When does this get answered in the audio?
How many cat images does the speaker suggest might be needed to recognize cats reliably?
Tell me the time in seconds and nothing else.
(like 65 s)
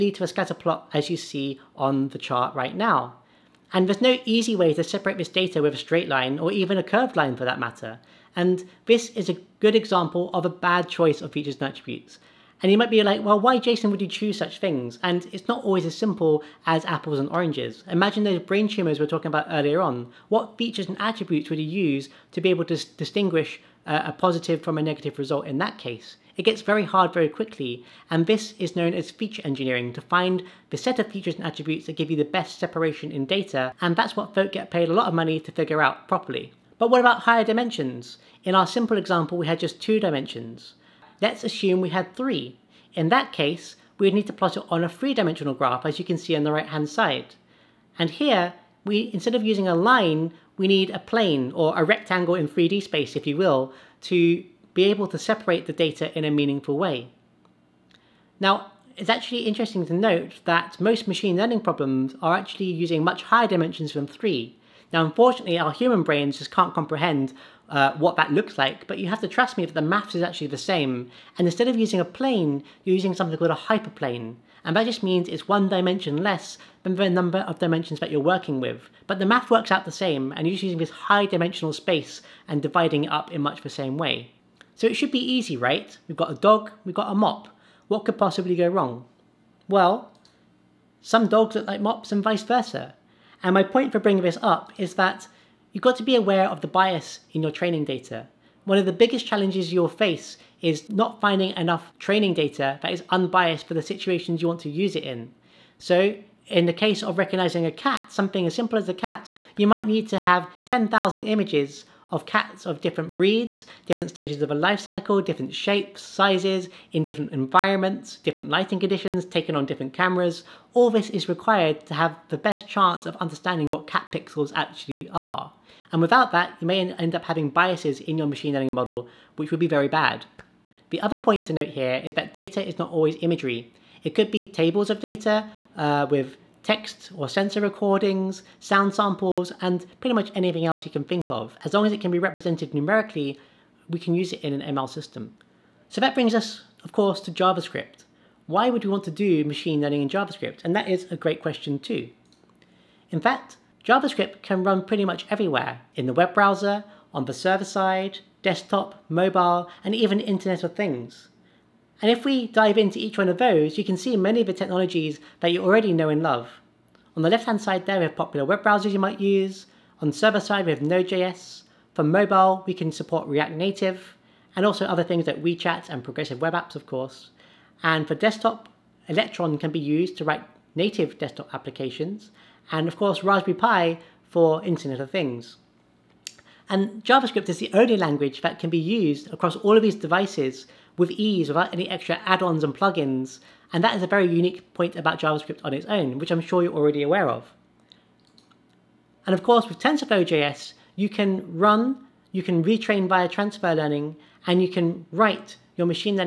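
110 s.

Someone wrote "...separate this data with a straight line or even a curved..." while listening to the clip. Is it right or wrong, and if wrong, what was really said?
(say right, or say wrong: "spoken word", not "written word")
right.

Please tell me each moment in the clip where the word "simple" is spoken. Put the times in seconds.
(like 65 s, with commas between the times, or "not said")
15 s, 38 s, 108 s.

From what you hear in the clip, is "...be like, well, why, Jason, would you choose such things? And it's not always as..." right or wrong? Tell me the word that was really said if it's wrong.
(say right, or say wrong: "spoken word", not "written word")
right.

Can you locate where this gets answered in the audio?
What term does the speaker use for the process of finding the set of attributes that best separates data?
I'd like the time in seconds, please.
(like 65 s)
29 s.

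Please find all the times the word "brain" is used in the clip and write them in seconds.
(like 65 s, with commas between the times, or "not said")
18 s, 66 s.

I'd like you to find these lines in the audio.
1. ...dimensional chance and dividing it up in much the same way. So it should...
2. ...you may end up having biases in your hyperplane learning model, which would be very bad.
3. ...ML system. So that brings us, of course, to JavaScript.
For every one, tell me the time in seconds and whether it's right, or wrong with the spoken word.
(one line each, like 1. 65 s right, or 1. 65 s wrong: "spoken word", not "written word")
1. 81 s wrong: "space", not "chance"
2. 126 s wrong: "machine", not "hyperplane"
3. 144 s right.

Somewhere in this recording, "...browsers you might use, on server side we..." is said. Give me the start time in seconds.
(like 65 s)
168 s.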